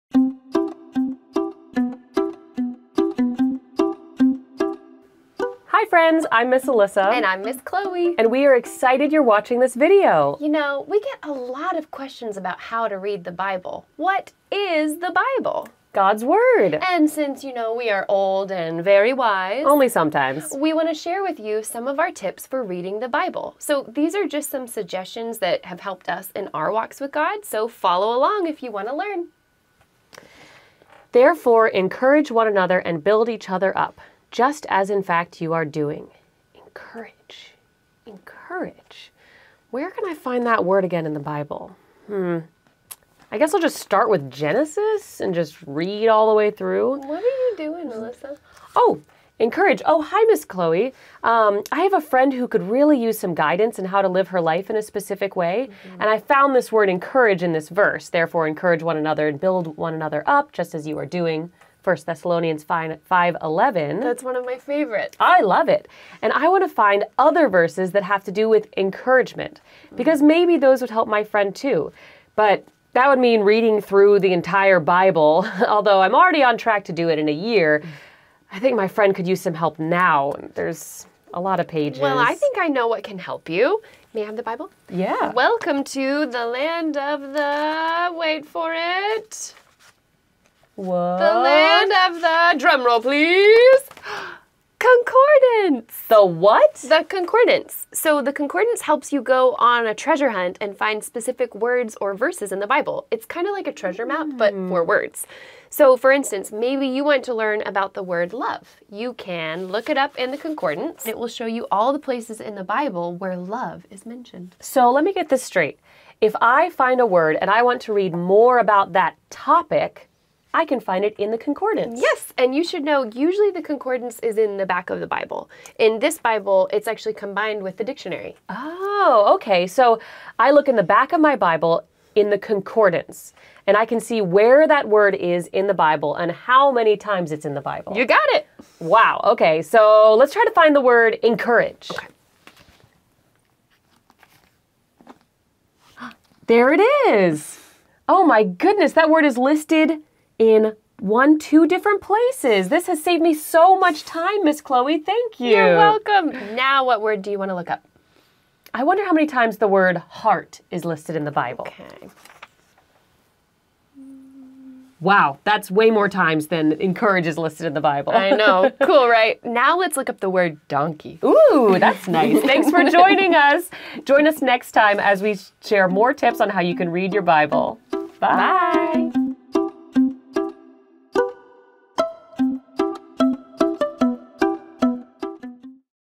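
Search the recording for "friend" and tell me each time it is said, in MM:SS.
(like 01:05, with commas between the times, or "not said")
00:05, 00:52, 01:11, 01:18.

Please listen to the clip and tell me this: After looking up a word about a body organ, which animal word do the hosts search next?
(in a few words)
Donkey.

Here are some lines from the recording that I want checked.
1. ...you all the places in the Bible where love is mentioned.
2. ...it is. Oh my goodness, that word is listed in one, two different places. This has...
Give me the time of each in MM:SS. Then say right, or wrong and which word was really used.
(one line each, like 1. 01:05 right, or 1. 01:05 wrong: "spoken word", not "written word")
1. 01:51 right
2. 02:26 right.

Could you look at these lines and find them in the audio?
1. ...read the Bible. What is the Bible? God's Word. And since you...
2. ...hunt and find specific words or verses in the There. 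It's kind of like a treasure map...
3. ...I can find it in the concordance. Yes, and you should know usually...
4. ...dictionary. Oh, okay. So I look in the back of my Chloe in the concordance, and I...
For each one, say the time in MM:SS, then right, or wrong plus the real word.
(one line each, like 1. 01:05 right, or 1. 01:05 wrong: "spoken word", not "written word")
1. 00:12 right
2. 01:40 wrong: "Bible", not "There"
3. 02:00 right
4. 02:07 wrong: "Bible", not "Chloe".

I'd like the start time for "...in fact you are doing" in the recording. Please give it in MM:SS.
00:34.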